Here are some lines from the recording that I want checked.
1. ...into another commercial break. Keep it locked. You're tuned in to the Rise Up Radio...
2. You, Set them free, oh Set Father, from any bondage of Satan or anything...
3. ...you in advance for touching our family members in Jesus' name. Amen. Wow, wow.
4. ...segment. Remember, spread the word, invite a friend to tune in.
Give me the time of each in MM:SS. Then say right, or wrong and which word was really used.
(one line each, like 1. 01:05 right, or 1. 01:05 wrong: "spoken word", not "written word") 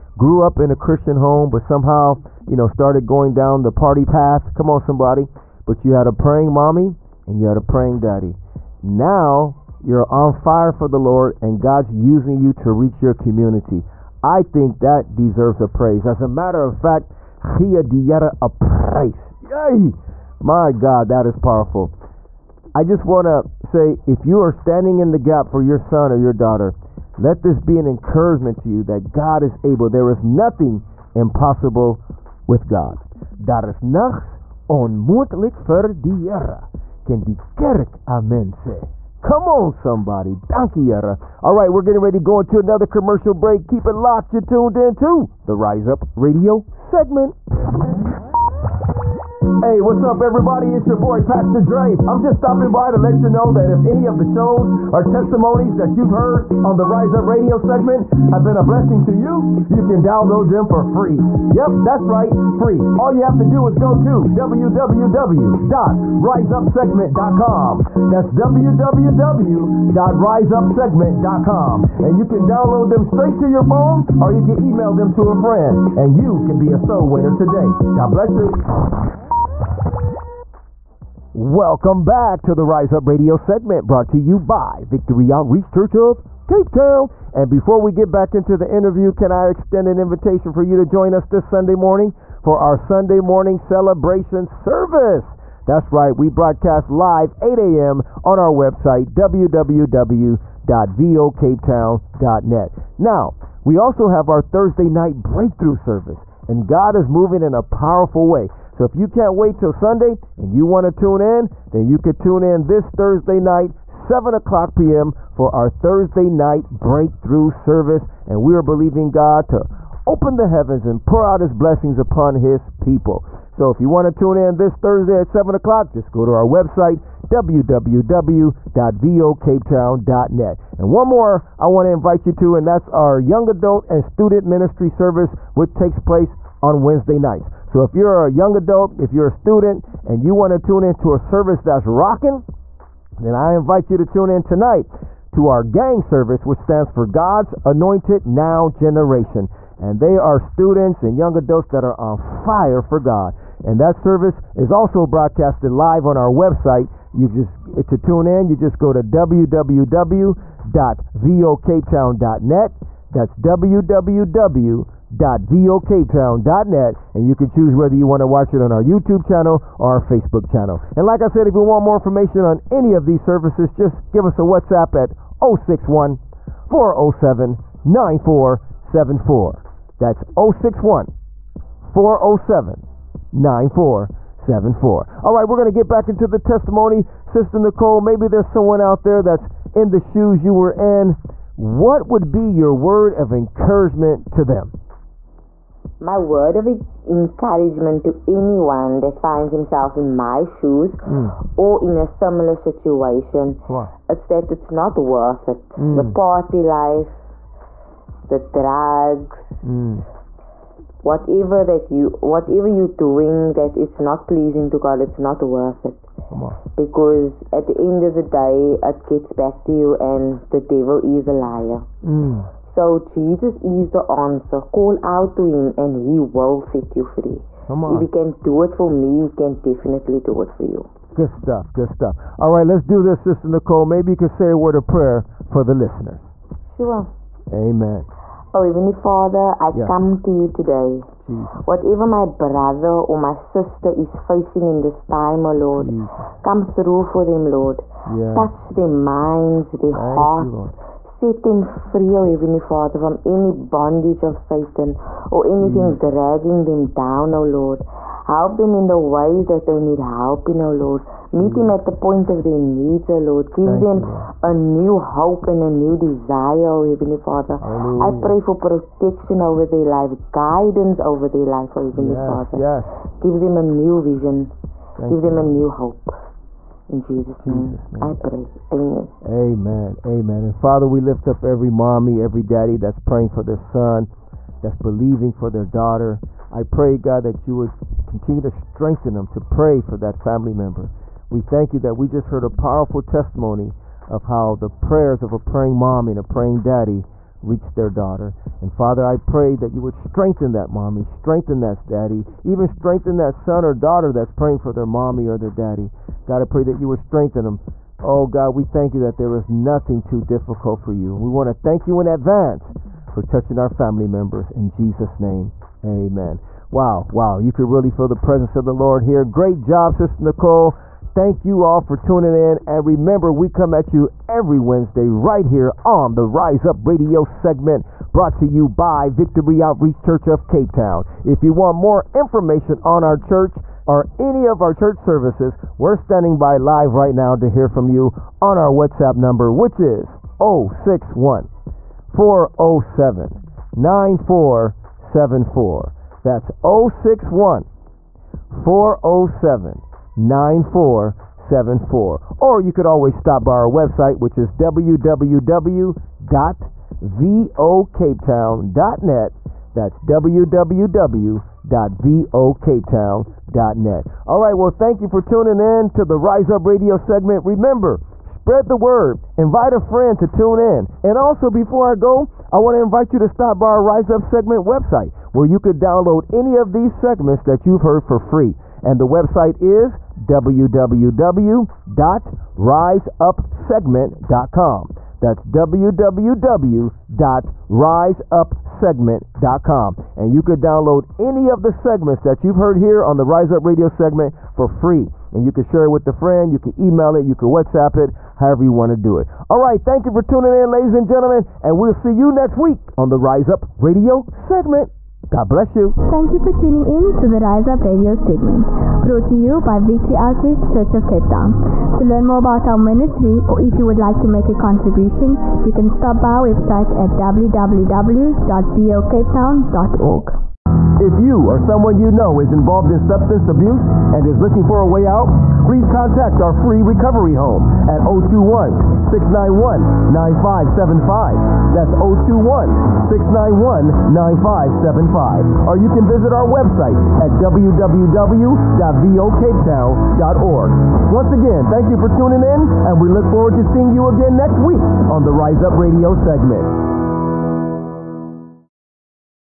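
1. 00:42 right
2. 04:10 wrong: "Heavenly", not "Set"
3. 05:11 right
4. 06:06 right.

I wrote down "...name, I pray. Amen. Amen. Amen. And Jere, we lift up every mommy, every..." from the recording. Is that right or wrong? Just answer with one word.
wrong.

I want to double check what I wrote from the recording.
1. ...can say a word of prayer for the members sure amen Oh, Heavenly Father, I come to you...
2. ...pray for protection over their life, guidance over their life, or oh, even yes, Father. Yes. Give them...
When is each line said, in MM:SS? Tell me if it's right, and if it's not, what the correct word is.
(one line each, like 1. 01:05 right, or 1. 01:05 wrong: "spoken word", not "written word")
1. 03:54 wrong: "listeners", not "members"
2. 04:28 right.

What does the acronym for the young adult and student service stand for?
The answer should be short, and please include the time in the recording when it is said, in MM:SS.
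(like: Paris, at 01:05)
God's Anointed Now Generation, at 02:27.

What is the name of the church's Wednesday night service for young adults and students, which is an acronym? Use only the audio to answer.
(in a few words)
GANG.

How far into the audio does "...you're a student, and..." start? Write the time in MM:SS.
02:19.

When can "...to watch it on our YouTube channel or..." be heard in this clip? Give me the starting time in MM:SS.
02:48.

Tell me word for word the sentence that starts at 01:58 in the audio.
And we are believing God to open the heavens and pour out his blessings upon his people.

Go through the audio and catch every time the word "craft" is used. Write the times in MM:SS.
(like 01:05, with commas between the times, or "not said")
not said.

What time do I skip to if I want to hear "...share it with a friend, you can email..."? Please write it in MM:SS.
06:35.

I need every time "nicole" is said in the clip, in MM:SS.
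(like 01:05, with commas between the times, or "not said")
03:07, 03:53, 05:20.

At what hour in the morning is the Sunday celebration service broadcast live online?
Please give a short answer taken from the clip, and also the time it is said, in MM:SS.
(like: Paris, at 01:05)
8 a.m., at 01:37.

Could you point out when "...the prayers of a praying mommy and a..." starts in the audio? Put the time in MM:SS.
04:54.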